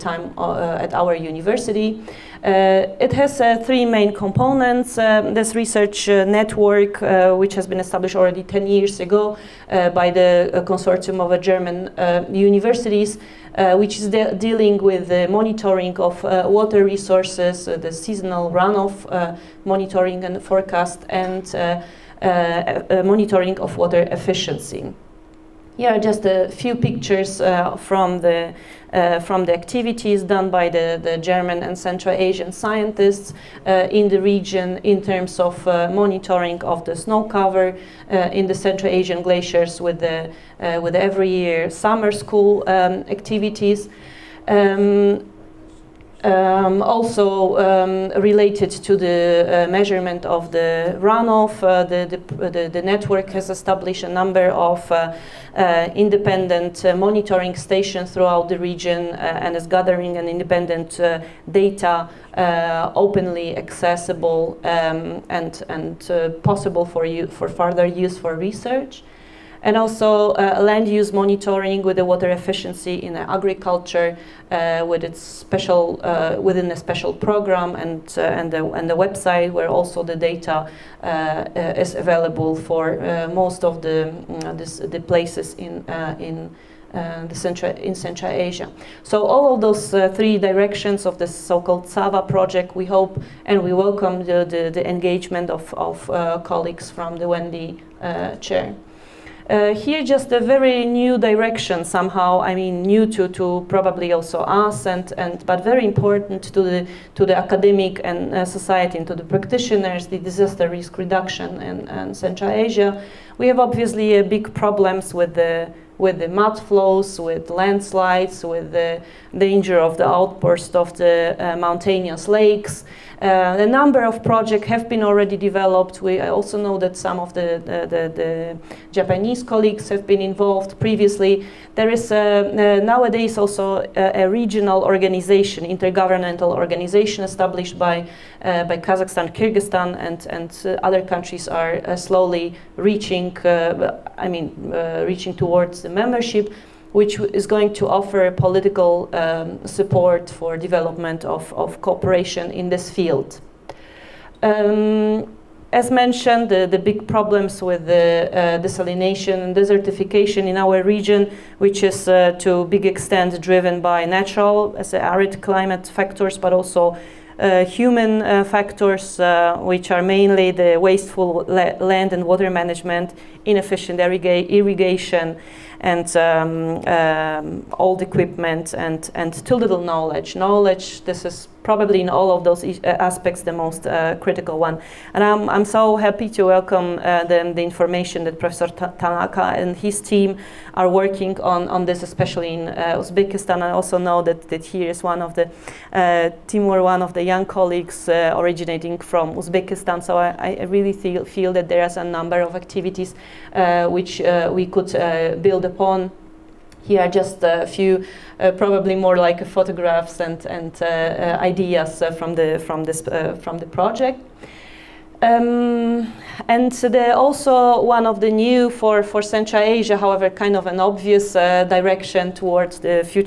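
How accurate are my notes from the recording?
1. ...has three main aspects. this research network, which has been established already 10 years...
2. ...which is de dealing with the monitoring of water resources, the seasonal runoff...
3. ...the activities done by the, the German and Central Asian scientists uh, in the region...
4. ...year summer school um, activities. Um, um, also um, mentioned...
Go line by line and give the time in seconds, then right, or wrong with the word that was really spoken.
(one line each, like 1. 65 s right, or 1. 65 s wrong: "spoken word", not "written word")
1. 3 s wrong: "components", not "aspects"
2. 13 s right
3. 29 s right
4. 41 s wrong: "related", not "mentioned".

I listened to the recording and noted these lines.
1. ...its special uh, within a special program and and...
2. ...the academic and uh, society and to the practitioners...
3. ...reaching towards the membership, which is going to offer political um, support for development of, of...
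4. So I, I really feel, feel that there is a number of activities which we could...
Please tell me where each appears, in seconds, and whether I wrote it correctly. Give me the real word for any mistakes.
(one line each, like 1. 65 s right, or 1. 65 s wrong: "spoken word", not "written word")
1. 75 s right
2. 107 s right
3. 145 s right
4. 200 s right.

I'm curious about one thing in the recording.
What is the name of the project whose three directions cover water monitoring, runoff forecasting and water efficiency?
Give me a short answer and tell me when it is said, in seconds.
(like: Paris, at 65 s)
CAWa project, at 91 s.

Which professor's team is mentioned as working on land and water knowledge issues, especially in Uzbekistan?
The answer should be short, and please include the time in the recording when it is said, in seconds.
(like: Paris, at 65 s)
Professor Tanaka, at 188 s.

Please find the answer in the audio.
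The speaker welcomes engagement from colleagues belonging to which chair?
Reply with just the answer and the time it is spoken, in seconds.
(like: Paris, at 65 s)
WENDI chair, at 97 s.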